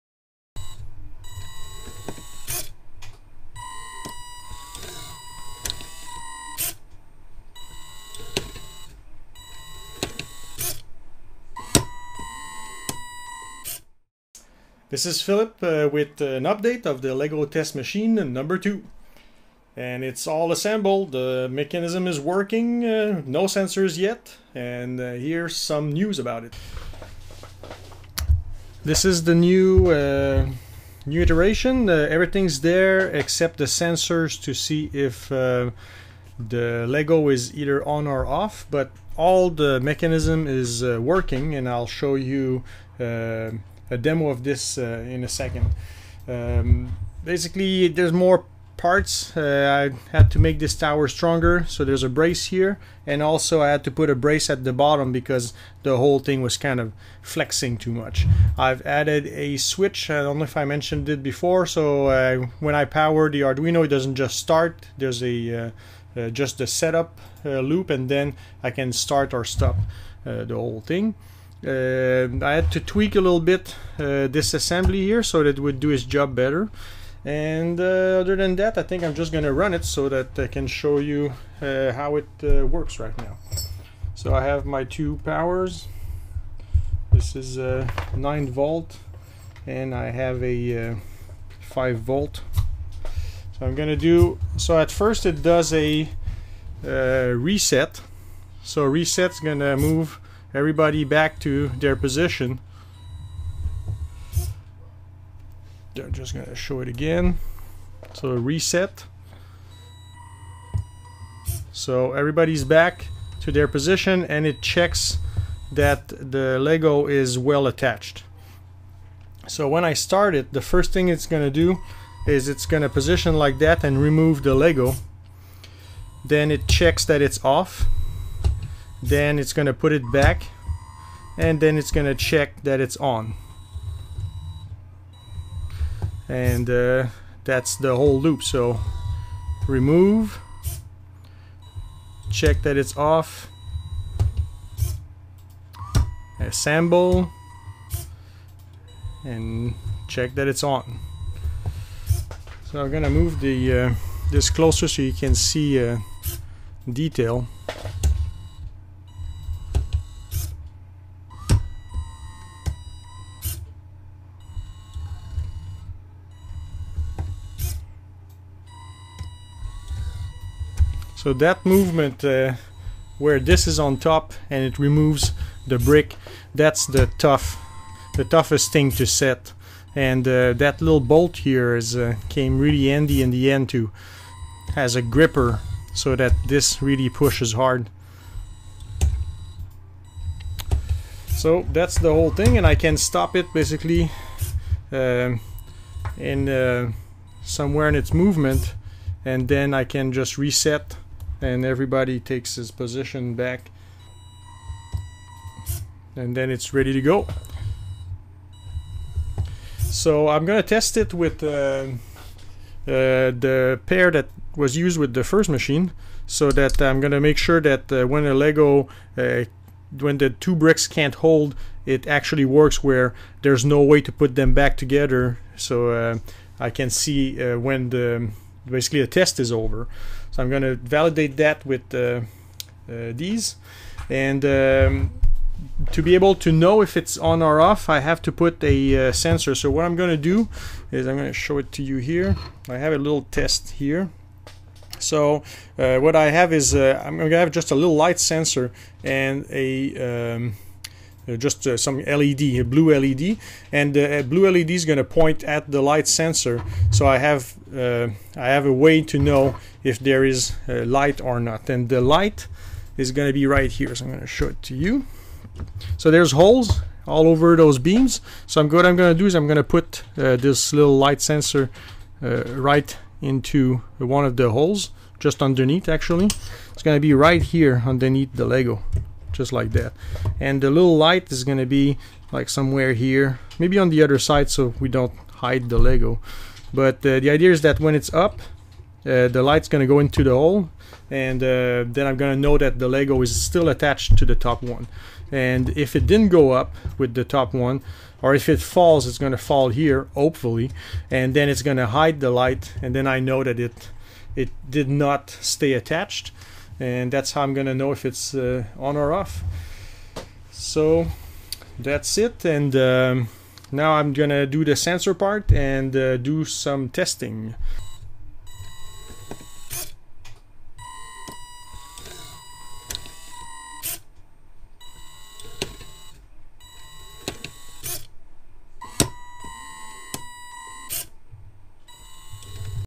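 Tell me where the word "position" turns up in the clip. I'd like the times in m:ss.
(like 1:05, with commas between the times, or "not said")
1:41, 1:53, 2:02, 3:22.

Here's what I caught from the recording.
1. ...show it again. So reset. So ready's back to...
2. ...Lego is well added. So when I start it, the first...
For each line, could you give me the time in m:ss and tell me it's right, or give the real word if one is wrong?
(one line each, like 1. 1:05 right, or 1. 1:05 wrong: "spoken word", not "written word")
1. 1:46 wrong: "everybody", not "ready"
2. 1:56 wrong: "attached", not "added".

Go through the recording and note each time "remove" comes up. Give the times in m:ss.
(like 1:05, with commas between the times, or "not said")
2:04, 2:19, 2:54.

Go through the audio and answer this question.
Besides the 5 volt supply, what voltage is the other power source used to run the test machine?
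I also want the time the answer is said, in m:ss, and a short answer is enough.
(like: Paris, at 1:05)
9 volt, at 1:28.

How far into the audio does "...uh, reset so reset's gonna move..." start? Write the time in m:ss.
1:36.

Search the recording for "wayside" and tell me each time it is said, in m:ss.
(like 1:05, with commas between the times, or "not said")
not said.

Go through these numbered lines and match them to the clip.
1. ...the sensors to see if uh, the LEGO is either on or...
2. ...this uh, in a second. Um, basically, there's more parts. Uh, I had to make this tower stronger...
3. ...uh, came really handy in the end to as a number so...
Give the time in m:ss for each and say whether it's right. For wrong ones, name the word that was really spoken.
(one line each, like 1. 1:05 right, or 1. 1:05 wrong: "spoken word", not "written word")
1. 0:33 right
2. 0:44 right
3. 3:01 wrong: "gripper", not "number".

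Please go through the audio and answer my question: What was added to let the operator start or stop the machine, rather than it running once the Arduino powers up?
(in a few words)
A switch.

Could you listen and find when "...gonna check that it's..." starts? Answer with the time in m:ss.
2:11.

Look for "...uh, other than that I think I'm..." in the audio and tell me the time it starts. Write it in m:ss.
1:17.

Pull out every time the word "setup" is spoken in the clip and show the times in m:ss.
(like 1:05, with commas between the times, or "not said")
1:06.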